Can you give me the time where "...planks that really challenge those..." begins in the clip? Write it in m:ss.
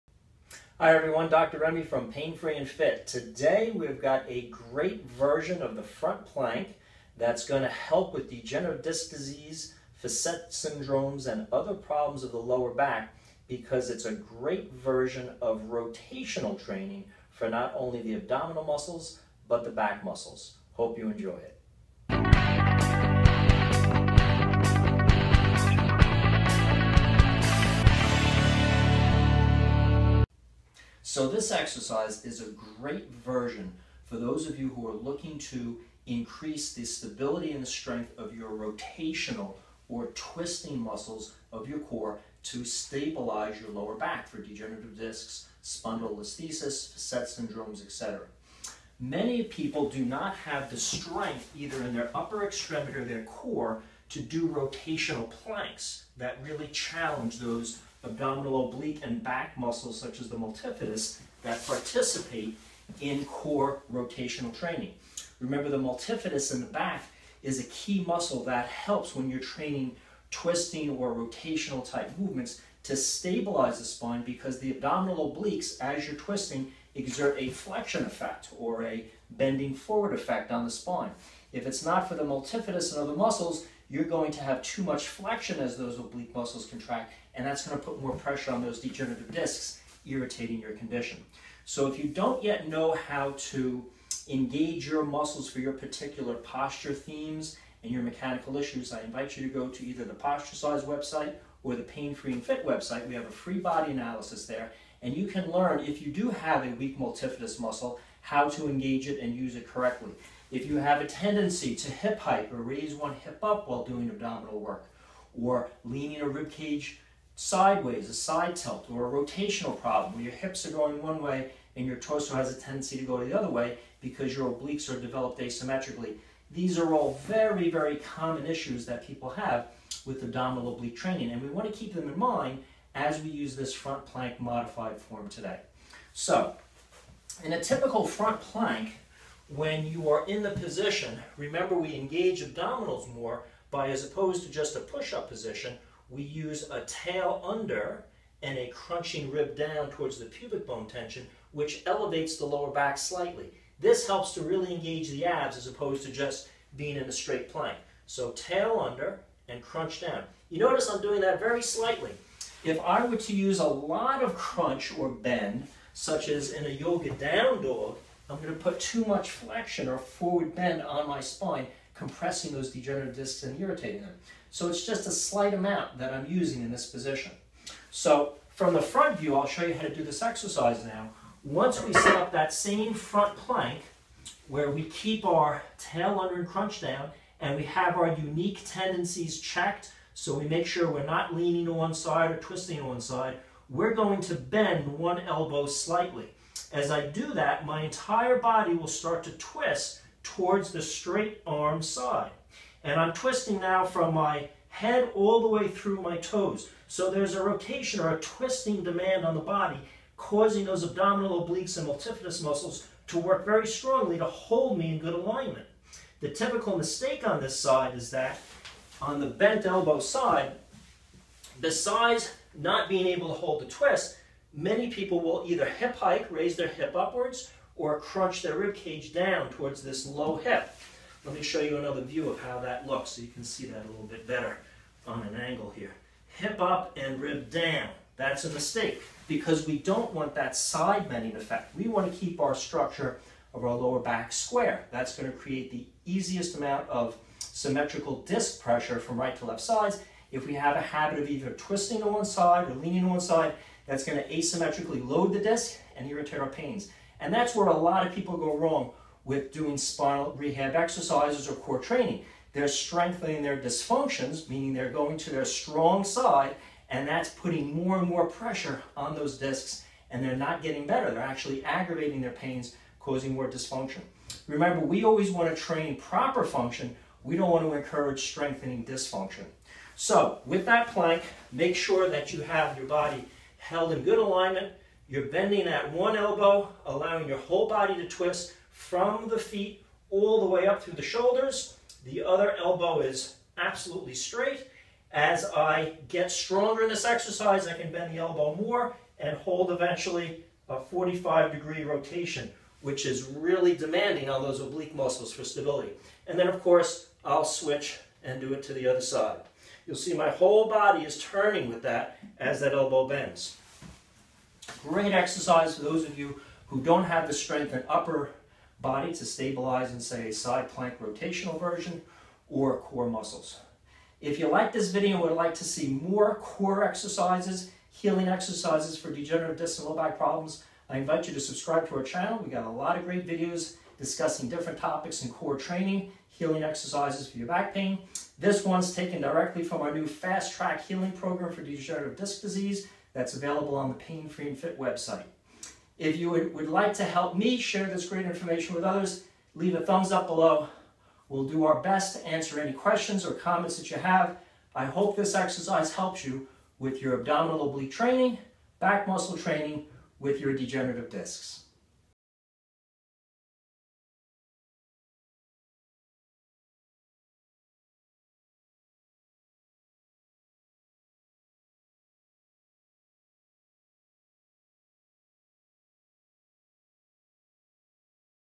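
0:55.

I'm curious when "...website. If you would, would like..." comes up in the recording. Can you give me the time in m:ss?
5:44.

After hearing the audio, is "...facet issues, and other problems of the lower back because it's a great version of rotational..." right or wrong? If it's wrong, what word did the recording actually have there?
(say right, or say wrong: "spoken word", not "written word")
wrong: "syndromes", not "issues".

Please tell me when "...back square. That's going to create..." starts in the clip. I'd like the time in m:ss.
4:03.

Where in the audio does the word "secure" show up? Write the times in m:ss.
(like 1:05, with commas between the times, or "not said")
not said.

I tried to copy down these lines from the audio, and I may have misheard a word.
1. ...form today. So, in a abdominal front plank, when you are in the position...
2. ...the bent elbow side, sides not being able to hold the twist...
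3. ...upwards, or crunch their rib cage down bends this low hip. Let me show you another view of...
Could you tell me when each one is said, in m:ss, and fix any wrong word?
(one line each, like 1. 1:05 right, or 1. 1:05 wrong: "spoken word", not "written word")
1. 2:14 wrong: "typical", not "abdominal"
2. 3:39 wrong: "besides", not "sides"
3. 3:46 wrong: "towards", not "bends".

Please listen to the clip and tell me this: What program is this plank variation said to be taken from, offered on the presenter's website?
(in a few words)
Fast Track Healing Program.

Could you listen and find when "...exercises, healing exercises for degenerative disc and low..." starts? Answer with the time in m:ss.
5:26.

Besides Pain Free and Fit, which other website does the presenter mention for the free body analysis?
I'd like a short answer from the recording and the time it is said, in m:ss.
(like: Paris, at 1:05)
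Posturecise, at 1:40.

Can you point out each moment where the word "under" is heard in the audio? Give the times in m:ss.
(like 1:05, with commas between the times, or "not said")
2:27, 2:38, 3:06.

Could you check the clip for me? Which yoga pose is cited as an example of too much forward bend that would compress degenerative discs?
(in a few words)
down dog.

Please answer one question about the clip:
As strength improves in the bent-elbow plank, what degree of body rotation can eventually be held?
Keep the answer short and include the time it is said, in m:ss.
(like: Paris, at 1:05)
45 degrees, at 5:00.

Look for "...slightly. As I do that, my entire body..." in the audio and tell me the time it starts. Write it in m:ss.
3:15.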